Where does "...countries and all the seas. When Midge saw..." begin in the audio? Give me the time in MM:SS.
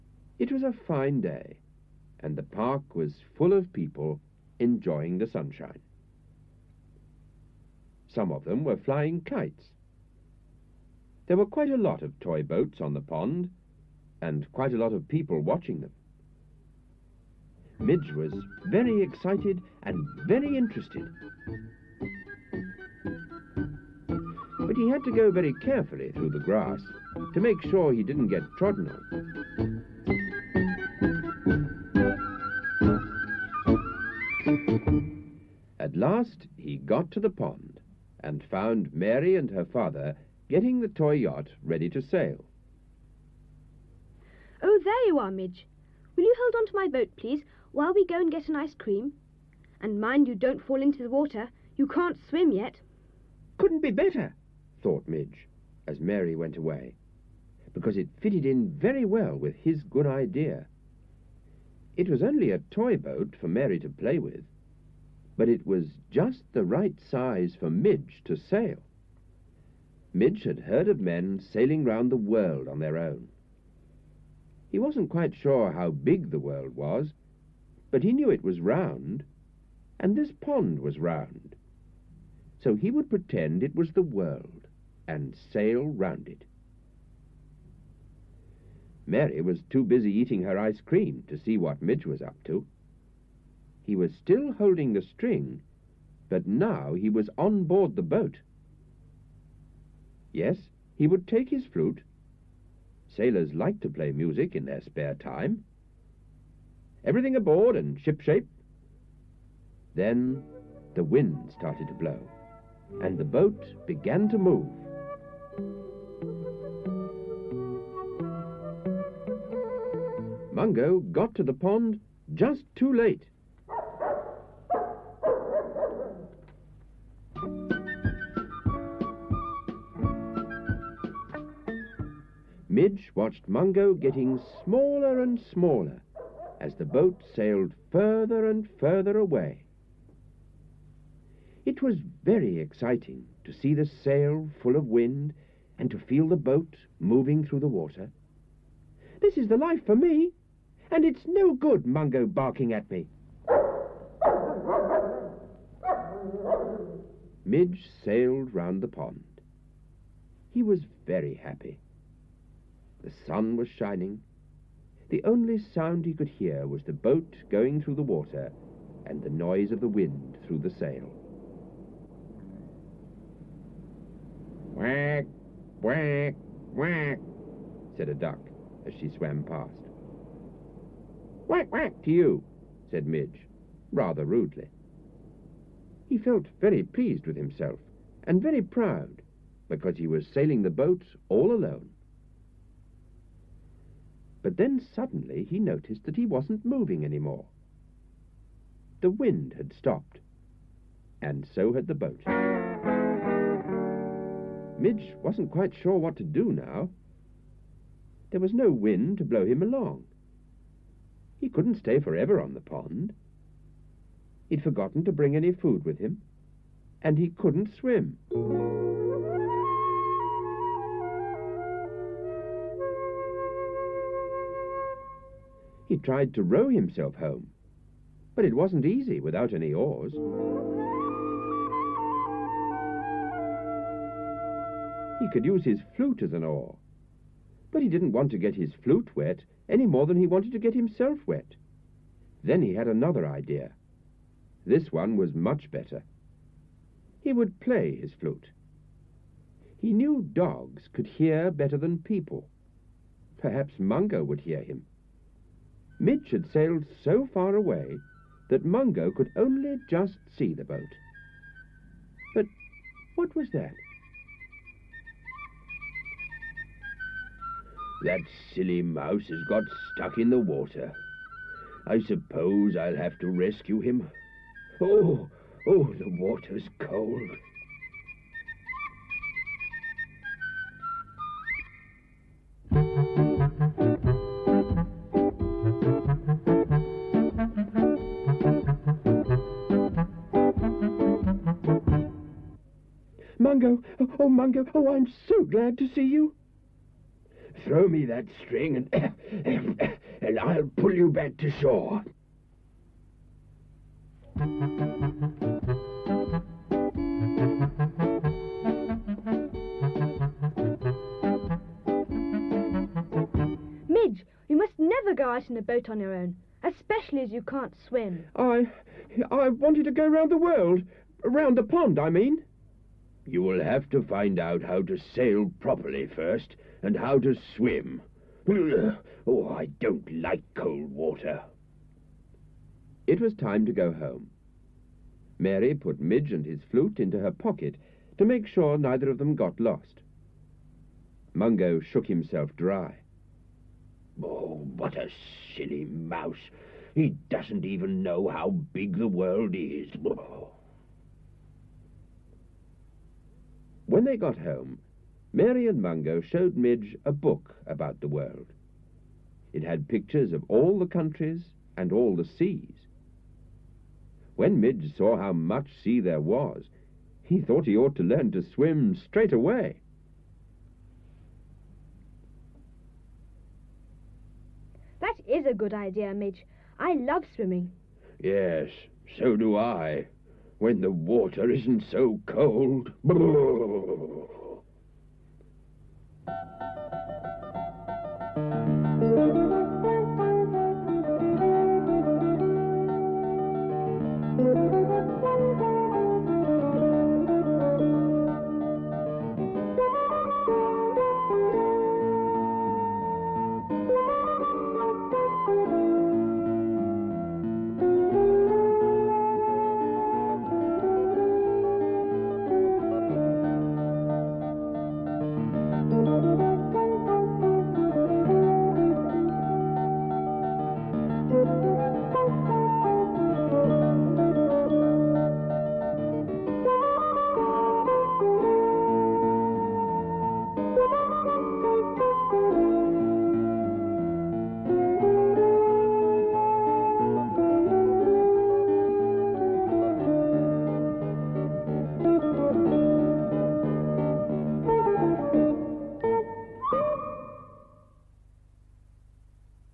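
06:00.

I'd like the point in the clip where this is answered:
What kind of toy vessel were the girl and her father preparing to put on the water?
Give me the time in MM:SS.
00:40.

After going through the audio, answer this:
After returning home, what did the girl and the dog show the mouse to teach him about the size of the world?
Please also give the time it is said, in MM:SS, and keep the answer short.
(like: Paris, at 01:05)
A book, at 05:57.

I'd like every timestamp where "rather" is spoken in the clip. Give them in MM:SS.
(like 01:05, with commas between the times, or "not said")
03:03.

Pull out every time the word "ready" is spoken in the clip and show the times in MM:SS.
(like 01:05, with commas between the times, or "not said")
00:41.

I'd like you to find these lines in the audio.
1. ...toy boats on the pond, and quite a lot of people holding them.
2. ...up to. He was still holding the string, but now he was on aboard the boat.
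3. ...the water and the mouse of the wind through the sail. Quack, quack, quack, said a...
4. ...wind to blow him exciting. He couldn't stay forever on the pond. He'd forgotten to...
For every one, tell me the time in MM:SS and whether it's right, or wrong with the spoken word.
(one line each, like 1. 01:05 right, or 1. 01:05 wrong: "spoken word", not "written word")
1. 00:12 wrong: "watching", not "holding"
2. 01:32 wrong: "board", not "aboard"
3. 02:47 wrong: "noise", not "mouse"
4. 03:28 wrong: "along", not "exciting".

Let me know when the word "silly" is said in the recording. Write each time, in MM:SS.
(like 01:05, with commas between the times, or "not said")
04:28, 05:45.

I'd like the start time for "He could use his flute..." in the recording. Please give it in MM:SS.
03:55.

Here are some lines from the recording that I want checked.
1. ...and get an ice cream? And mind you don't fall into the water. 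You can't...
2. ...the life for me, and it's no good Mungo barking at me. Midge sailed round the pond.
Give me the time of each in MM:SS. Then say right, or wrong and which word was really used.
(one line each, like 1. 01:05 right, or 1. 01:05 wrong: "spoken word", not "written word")
1. 00:48 right
2. 02:29 right.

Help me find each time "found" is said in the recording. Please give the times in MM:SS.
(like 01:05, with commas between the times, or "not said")
00:38.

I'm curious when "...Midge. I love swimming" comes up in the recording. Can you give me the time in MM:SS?
06:16.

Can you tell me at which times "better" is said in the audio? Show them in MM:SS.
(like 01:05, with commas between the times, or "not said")
00:53, 04:05, 04:11.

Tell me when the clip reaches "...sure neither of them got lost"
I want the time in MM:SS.
05:38.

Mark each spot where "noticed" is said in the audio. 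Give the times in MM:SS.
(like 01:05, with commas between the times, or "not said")
03:15.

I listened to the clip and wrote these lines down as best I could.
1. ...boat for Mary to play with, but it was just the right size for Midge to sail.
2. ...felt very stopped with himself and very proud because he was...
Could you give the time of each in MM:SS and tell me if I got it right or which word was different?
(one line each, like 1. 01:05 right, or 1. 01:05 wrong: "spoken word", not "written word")
1. 01:02 right
2. 03:06 wrong: "pleased", not "stopped".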